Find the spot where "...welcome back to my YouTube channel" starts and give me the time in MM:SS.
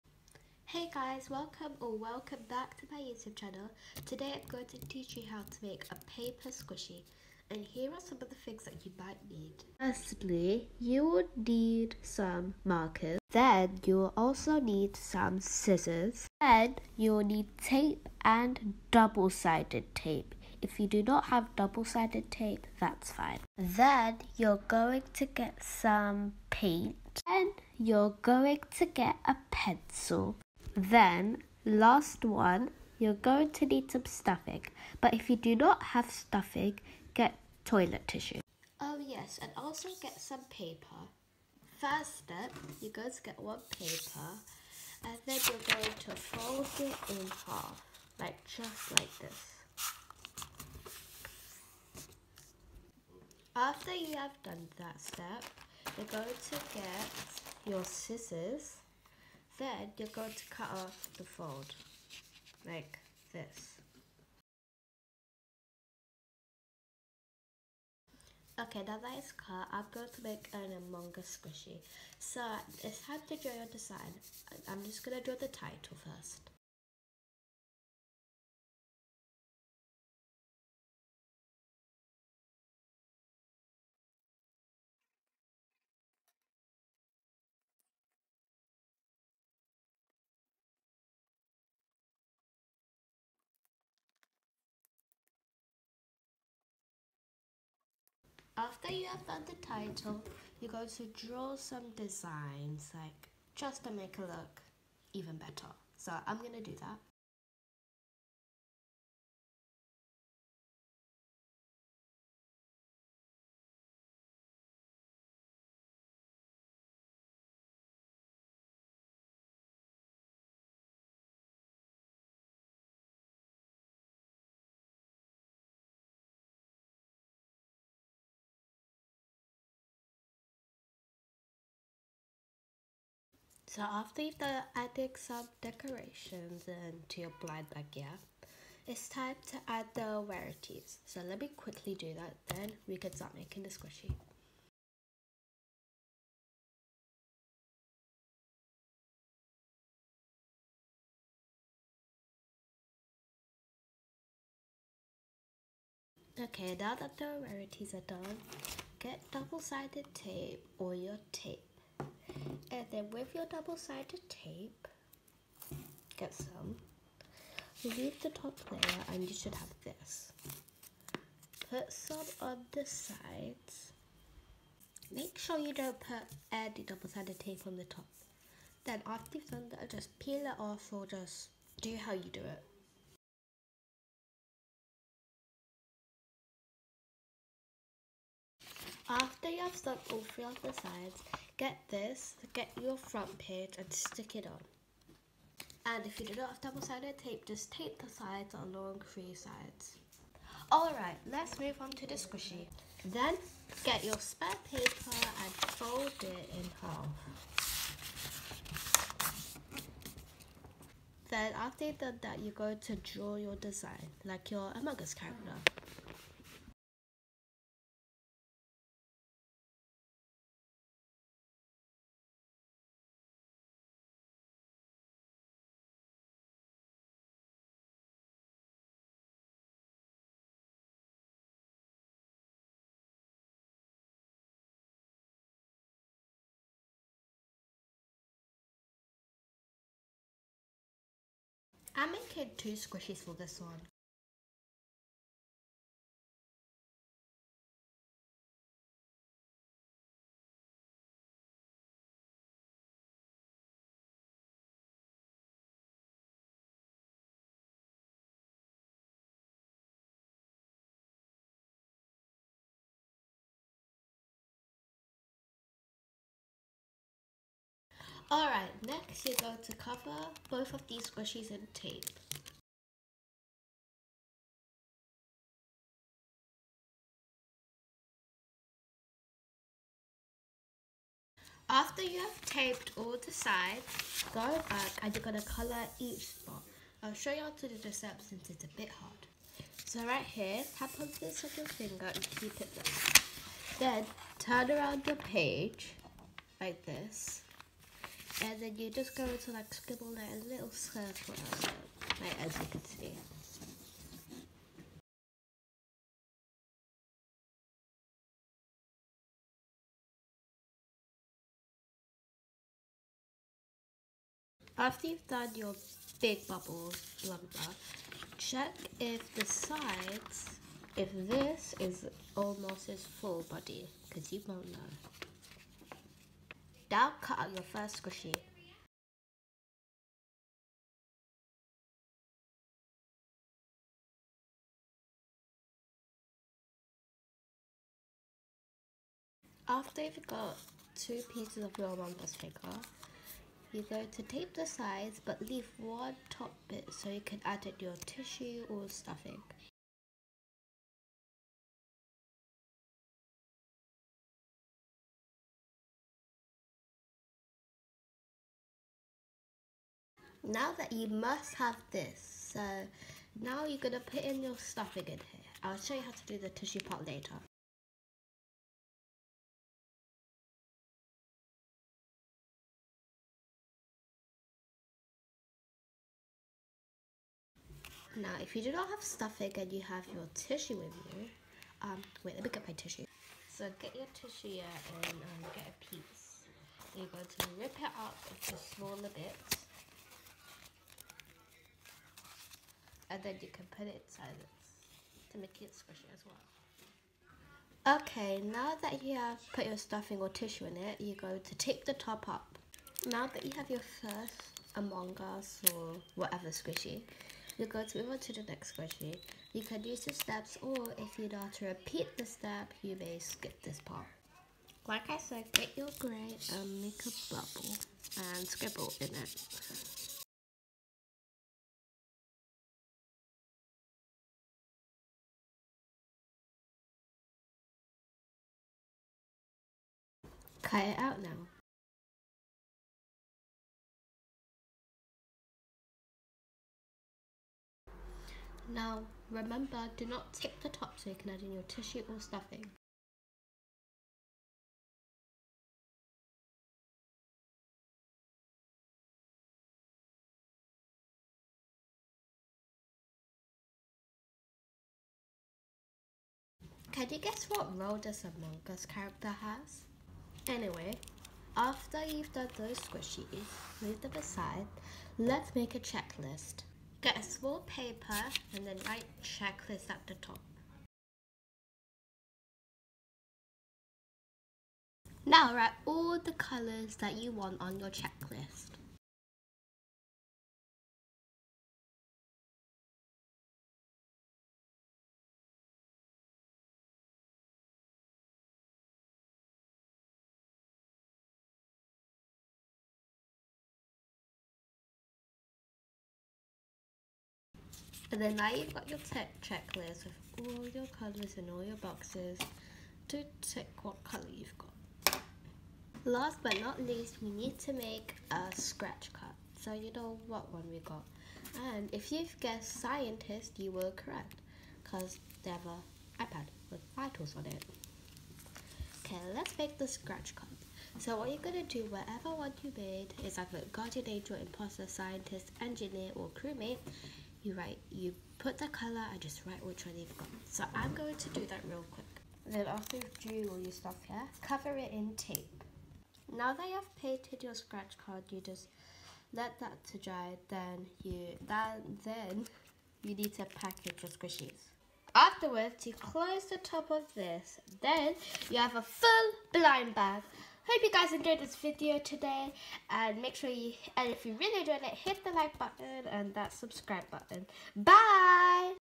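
00:01.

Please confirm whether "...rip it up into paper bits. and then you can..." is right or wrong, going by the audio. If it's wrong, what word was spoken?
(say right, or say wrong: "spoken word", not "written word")
wrong: "smaller", not "paper".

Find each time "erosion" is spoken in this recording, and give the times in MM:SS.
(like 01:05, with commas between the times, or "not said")
not said.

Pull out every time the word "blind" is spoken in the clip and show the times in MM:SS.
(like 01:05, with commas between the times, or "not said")
02:17, 09:09.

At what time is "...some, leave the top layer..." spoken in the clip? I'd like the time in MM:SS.
02:46.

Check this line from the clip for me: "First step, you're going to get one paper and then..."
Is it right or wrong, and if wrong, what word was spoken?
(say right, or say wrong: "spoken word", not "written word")
right.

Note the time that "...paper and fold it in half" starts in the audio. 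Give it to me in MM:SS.
03:24.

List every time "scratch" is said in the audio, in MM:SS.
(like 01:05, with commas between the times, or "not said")
08:28, 08:39, 08:57.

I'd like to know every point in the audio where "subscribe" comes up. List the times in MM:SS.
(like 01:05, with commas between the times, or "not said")
09:16.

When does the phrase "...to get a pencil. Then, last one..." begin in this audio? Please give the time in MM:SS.
00:28.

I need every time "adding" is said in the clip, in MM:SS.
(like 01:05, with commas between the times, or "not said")
02:14.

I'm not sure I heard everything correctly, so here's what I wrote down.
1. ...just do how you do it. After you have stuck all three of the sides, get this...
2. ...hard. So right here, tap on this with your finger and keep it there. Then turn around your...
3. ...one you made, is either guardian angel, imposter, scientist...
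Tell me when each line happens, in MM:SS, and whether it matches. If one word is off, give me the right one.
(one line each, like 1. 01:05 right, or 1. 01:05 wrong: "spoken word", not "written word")
1. 03:01 right
2. 04:48 right
3. 08:42 right.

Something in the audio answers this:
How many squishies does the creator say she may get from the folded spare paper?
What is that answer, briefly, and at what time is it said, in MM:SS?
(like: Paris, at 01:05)
2, at 04:02.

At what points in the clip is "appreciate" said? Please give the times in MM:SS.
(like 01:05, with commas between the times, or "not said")
not said.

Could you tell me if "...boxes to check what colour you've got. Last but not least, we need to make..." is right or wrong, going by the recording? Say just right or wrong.
right.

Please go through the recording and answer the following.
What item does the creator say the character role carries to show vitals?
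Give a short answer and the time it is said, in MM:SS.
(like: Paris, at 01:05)
An iPad, at 08:35.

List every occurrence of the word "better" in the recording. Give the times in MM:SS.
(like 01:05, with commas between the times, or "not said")
01:45.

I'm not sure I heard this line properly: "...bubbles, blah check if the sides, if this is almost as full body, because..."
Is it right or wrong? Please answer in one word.
right.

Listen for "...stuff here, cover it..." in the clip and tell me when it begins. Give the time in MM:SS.
08:53.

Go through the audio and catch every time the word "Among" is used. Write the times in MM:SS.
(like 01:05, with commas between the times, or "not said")
01:10, 03:34, 05:41, 06:44, 07:38.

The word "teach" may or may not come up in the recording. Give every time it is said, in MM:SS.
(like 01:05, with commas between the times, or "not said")
00:04.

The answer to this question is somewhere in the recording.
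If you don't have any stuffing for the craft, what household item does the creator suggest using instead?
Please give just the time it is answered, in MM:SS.
00:37.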